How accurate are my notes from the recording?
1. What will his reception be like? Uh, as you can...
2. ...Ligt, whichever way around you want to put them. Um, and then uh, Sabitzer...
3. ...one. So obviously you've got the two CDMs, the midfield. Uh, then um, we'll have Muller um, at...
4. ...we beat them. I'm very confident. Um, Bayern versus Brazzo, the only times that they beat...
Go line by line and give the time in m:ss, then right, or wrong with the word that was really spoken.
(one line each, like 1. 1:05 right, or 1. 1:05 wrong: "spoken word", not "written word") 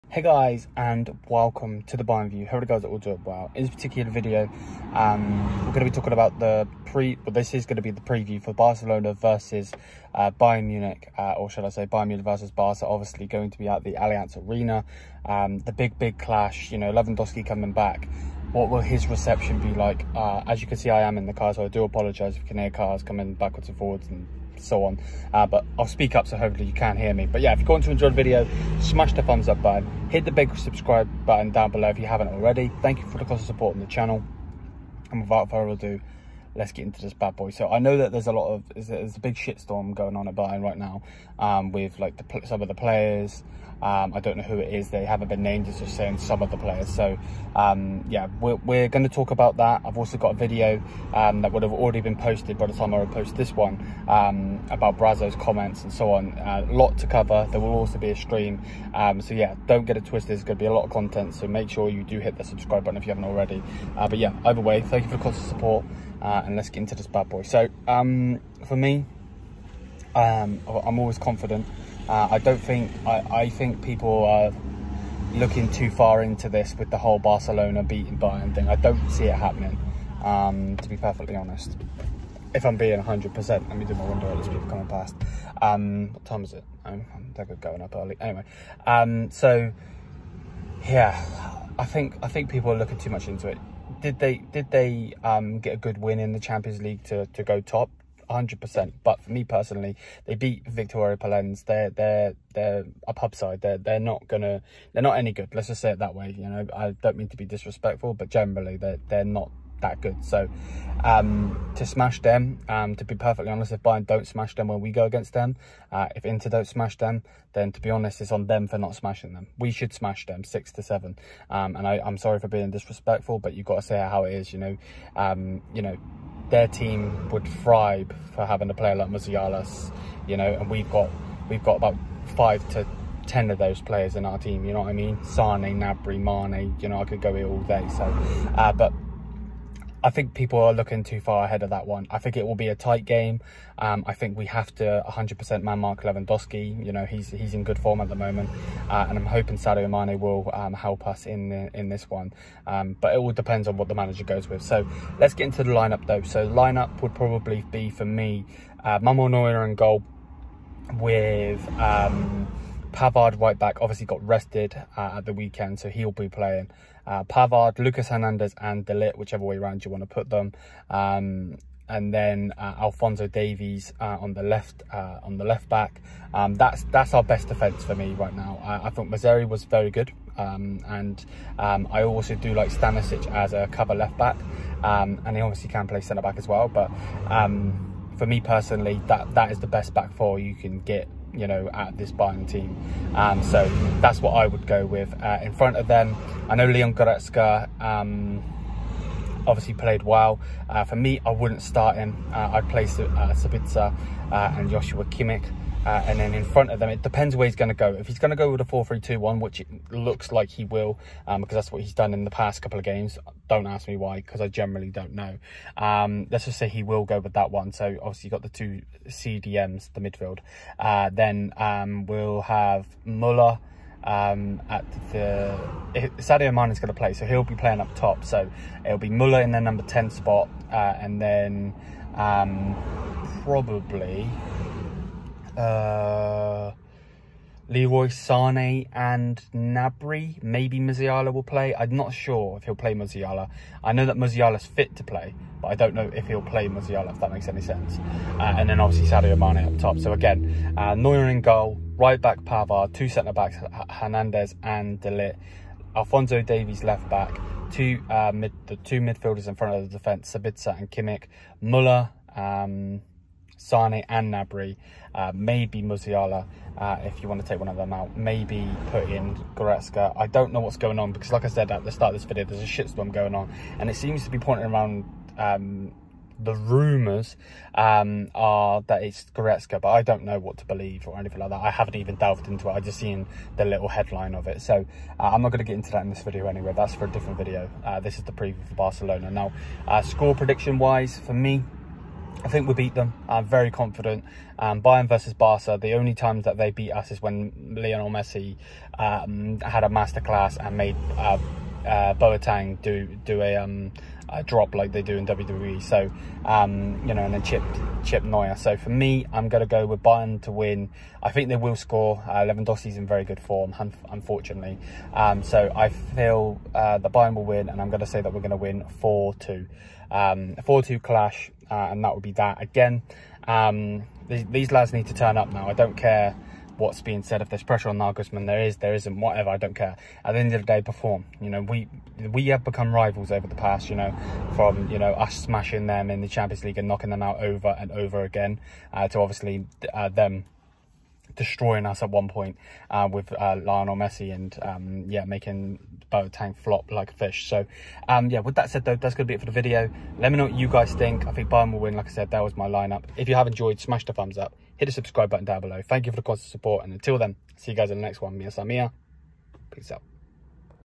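1. 0:18 right
2. 2:48 wrong: "Alphonso", not "Sabitzer"
3. 3:37 right
4. 4:52 wrong: "Barca", not "Brazzo".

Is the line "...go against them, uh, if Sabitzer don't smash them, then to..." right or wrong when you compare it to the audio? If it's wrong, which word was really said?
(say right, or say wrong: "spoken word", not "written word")
wrong: "Inter", not "Sabitzer".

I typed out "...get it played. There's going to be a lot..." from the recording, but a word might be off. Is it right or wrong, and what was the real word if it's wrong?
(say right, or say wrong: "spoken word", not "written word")
wrong: "twisted", not "played".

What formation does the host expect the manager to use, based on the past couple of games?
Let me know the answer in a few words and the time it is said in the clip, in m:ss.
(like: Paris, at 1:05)
4-3-2-1, at 3:28.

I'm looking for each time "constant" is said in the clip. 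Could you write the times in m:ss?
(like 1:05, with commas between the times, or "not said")
0:33, 1:05, 5:56.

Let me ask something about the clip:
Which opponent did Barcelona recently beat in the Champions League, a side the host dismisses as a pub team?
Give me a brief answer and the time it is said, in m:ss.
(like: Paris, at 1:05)
Viktoria Plzen, at 1:40.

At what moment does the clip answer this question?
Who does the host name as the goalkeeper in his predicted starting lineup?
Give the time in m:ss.
2:39.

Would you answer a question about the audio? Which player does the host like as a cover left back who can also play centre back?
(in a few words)
Stanisic.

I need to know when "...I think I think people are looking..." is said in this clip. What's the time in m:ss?
1:31.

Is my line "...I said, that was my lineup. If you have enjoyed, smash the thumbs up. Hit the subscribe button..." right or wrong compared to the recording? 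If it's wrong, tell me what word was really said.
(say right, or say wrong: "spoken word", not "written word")
right.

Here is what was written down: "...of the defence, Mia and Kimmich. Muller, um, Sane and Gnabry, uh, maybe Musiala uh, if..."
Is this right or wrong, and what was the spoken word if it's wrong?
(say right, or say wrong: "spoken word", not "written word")
wrong: "Sabitzer", not "Mia".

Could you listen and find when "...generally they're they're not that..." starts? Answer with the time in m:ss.
1:48.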